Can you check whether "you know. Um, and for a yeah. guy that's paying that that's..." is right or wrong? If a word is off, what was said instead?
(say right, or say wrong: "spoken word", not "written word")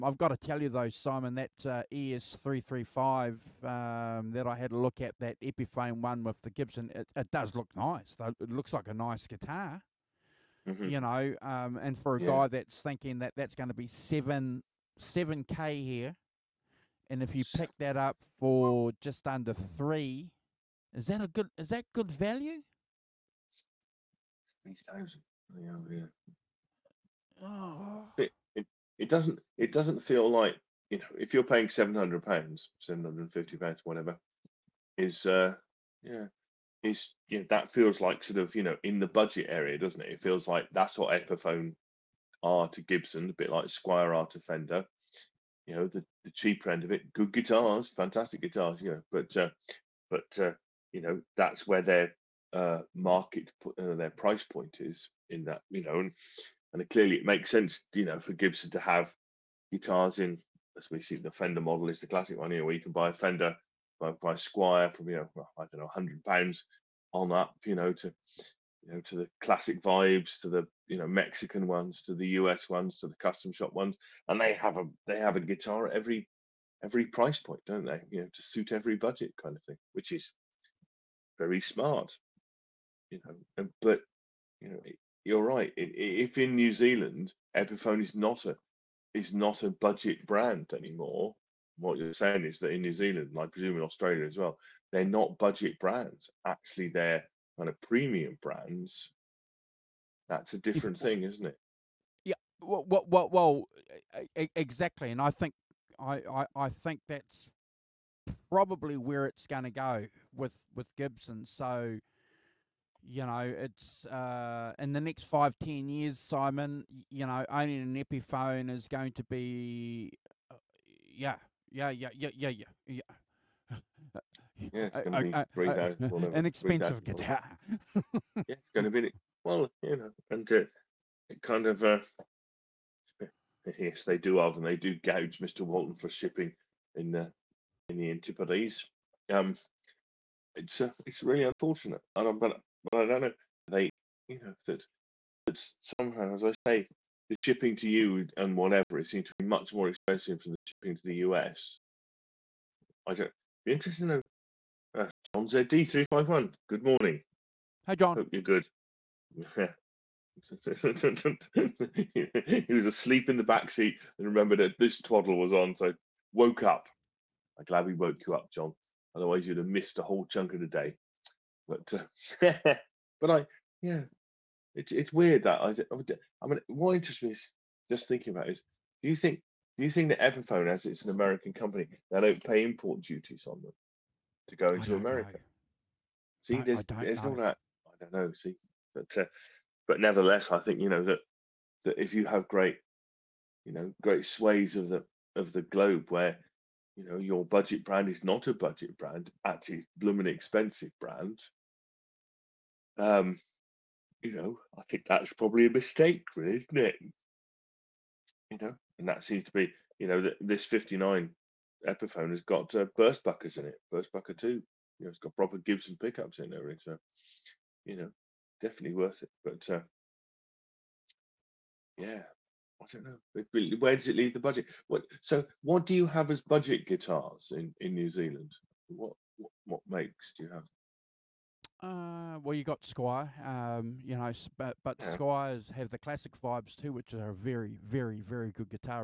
wrong: "thinking", not "paying".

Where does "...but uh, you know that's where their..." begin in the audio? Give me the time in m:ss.
0:50.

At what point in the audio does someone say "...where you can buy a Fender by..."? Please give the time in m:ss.
1:02.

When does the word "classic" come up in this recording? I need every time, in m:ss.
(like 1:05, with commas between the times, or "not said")
1:02, 1:09, 3:55.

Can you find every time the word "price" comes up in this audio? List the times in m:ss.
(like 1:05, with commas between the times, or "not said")
0:54, 1:17.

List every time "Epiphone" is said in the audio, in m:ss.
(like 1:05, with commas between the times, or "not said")
0:05, 0:41, 1:27, 1:58, 3:00, 3:31.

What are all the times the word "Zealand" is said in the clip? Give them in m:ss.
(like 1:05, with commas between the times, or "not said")
1:26, 1:32, 3:48.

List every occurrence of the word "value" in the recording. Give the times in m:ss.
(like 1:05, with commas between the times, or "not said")
0:22.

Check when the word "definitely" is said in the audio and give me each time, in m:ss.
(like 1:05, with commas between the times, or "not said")
3:38.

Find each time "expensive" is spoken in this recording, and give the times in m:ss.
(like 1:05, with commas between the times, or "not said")
2:06, 2:29, 3:20.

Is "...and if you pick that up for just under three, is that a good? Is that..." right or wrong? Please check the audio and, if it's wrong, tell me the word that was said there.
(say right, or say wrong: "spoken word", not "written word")
right.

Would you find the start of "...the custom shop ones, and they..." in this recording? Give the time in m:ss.
1:13.